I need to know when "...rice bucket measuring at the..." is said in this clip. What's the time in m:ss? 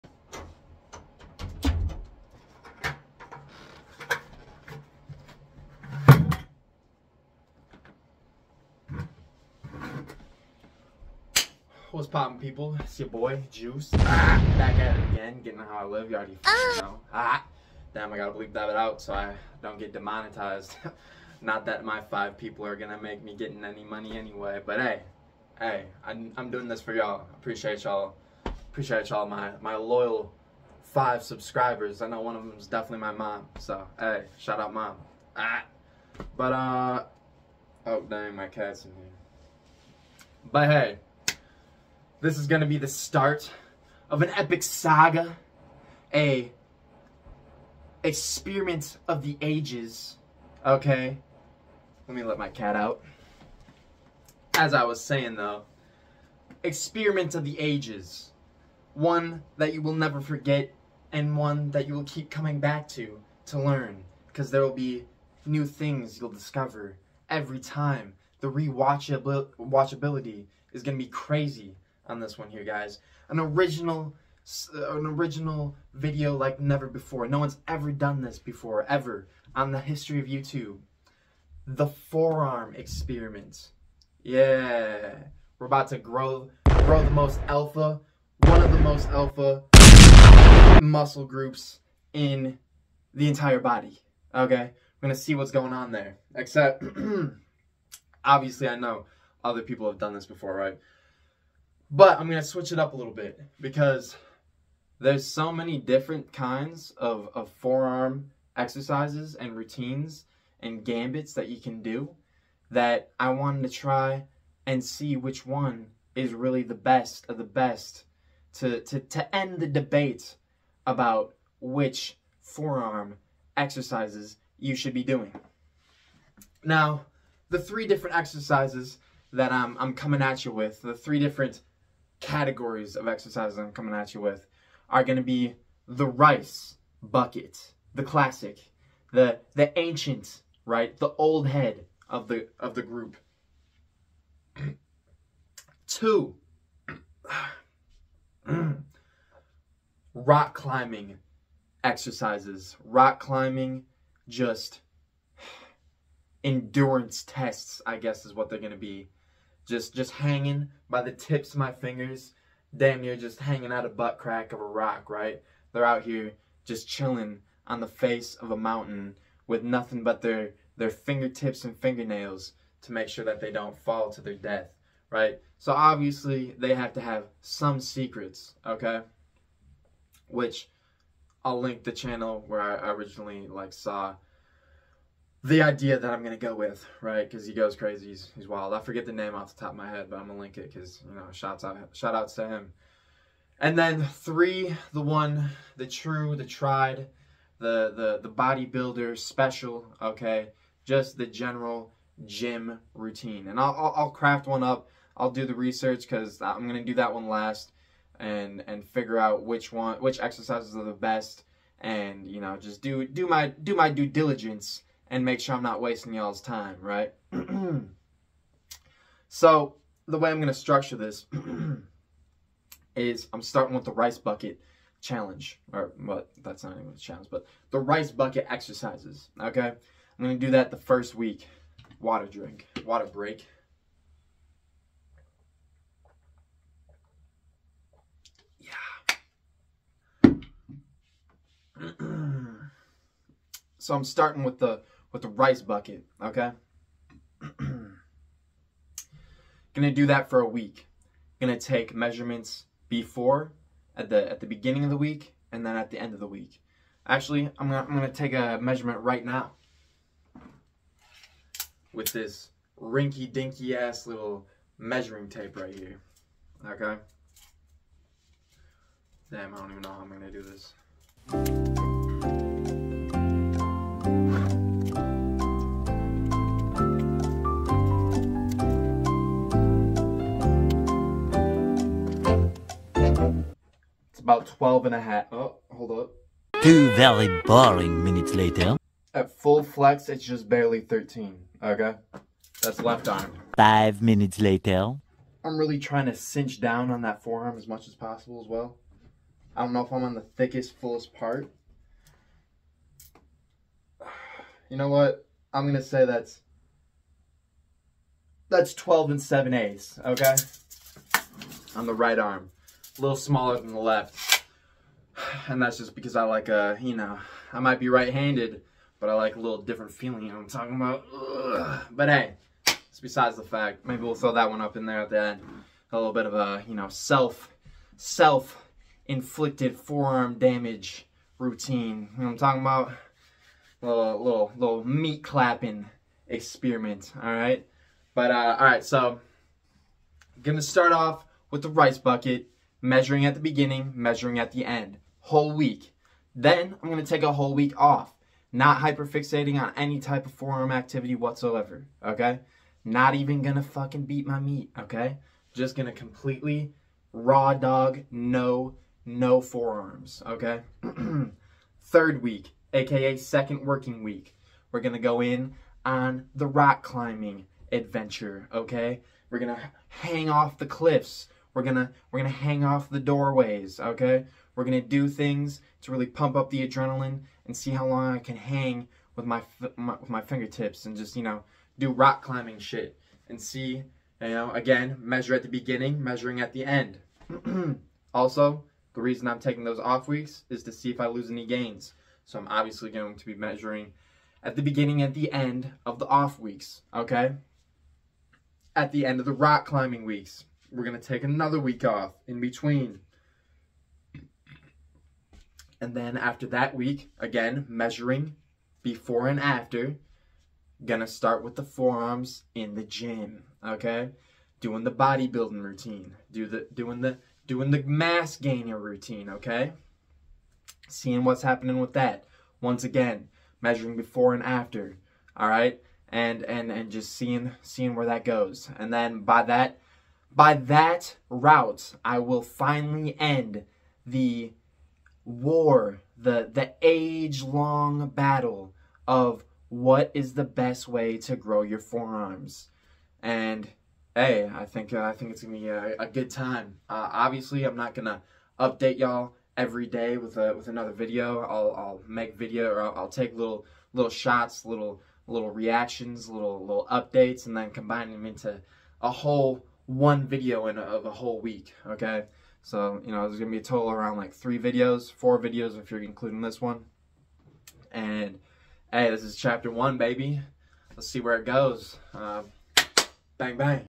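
5:41.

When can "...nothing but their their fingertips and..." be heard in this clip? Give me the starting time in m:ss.
2:49.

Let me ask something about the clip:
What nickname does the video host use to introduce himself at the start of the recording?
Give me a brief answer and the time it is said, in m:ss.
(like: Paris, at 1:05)
Juice, at 0:13.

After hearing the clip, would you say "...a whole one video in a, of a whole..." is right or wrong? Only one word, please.
right.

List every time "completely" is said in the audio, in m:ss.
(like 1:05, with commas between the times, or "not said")
5:55.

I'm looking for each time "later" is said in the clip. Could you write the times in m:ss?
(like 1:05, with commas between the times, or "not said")
4:48, 4:54.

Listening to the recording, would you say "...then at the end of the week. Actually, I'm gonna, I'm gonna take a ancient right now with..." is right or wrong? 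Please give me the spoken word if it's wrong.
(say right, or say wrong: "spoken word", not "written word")
wrong: "measurement", not "ancient".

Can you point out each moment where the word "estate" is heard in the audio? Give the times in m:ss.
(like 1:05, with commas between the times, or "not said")
not said.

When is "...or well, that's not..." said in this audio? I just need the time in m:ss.
3:45.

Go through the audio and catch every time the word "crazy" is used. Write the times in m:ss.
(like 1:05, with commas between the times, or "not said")
1:11, 3:07.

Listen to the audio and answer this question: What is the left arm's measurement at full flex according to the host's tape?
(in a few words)
13.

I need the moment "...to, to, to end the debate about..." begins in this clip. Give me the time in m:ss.
1:58.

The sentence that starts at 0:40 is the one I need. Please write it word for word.
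But hey, this is going to be the start of an epic saga, a experiment of the ages.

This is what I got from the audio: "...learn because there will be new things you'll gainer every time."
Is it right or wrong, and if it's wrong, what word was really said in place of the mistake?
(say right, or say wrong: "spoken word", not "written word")
wrong: "discover", not "gainer".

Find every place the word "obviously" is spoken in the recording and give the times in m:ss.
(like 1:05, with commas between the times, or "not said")
1:38, 2:55, 6:32, 7:27.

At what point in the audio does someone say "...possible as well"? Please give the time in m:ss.
4:57.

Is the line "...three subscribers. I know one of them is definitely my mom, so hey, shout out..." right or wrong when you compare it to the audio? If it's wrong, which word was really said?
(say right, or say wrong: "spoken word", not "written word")
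wrong: "five", not "three".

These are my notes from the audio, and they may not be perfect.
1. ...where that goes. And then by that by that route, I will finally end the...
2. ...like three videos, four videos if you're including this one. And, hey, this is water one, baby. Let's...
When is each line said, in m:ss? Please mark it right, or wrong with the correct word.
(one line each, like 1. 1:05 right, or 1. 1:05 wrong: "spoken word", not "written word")
1. 7:07 right
2. 7:44 wrong: "chapter", not "water".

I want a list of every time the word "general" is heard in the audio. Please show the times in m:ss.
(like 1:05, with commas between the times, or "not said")
3:21.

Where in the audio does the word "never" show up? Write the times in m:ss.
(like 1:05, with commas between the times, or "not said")
0:59, 1:16.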